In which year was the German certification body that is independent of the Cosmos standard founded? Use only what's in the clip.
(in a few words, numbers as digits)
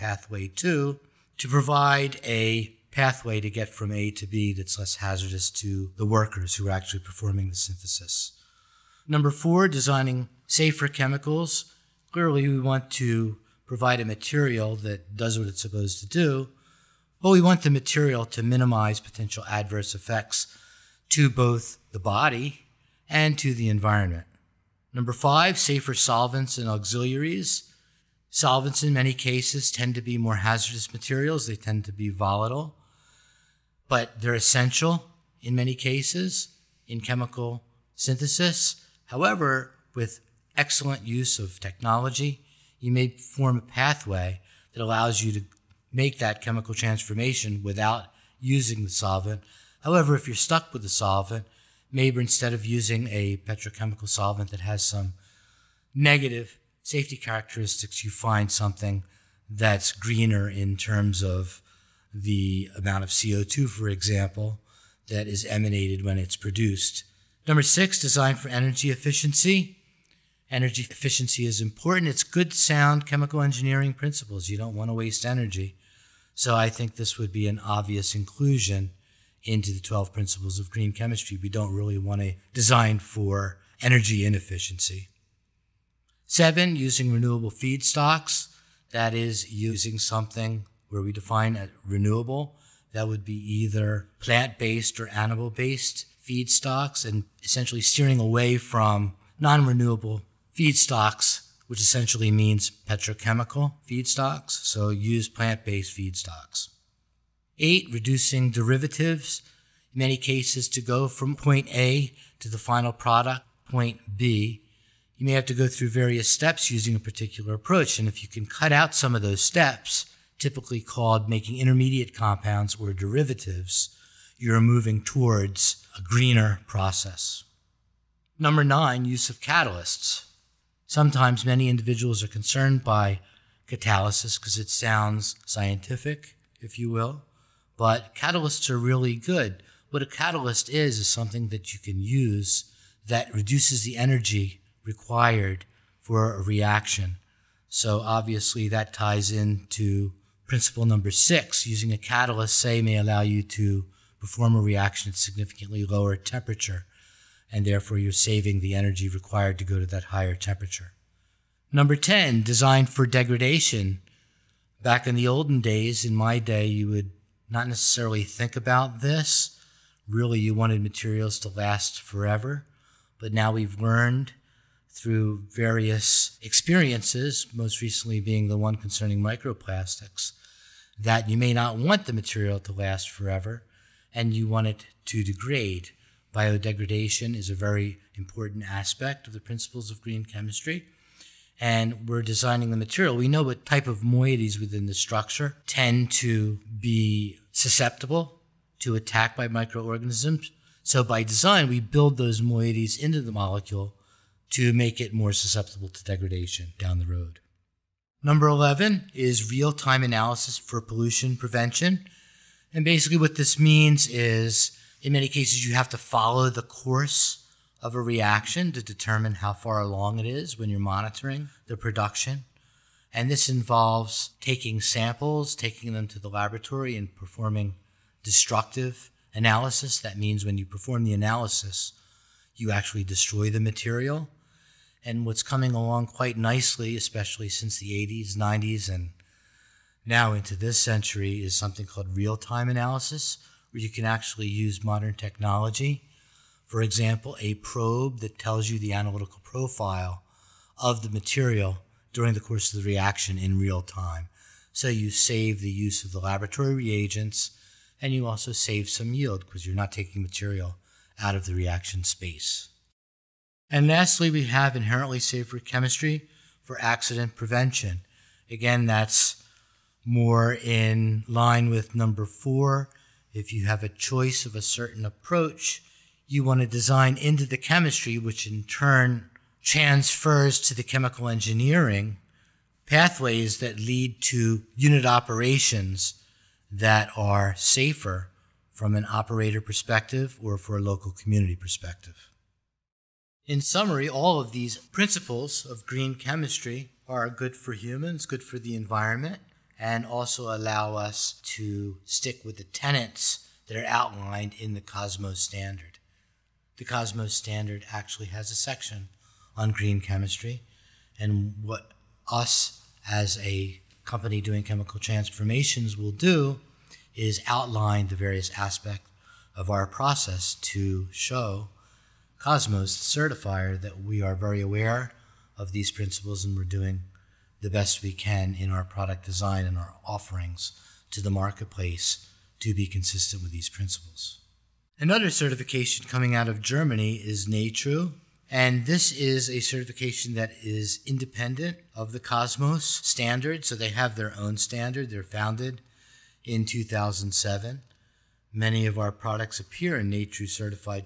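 2007.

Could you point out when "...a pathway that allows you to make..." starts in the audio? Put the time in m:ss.
0:43.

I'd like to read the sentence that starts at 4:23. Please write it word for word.
And lastly, we have inherently safer chemistry for accident prevention.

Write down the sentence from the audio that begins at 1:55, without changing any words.
You may have to go through various steps using a particular approach.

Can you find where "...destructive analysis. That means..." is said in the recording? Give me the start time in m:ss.
3:48.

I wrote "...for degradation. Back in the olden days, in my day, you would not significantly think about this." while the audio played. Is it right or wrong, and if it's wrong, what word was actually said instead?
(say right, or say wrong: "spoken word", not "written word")
wrong: "necessarily", not "significantly".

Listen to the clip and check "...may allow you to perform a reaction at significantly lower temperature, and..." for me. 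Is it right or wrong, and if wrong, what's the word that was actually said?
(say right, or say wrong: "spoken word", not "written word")
right.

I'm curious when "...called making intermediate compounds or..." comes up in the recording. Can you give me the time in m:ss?
2:00.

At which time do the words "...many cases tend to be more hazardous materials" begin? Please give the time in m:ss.
0:28.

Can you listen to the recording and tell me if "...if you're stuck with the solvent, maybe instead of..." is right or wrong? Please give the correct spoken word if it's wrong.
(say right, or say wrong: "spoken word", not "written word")
right.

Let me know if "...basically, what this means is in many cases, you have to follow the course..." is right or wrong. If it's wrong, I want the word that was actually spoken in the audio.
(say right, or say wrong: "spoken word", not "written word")
right.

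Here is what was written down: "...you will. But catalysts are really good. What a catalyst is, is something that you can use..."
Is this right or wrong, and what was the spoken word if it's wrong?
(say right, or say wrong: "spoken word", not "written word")
right.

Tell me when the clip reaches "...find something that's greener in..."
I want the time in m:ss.
0:58.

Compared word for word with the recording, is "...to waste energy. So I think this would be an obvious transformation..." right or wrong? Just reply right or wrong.
wrong.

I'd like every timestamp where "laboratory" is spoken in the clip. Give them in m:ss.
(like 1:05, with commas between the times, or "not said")
3:46, 4:16.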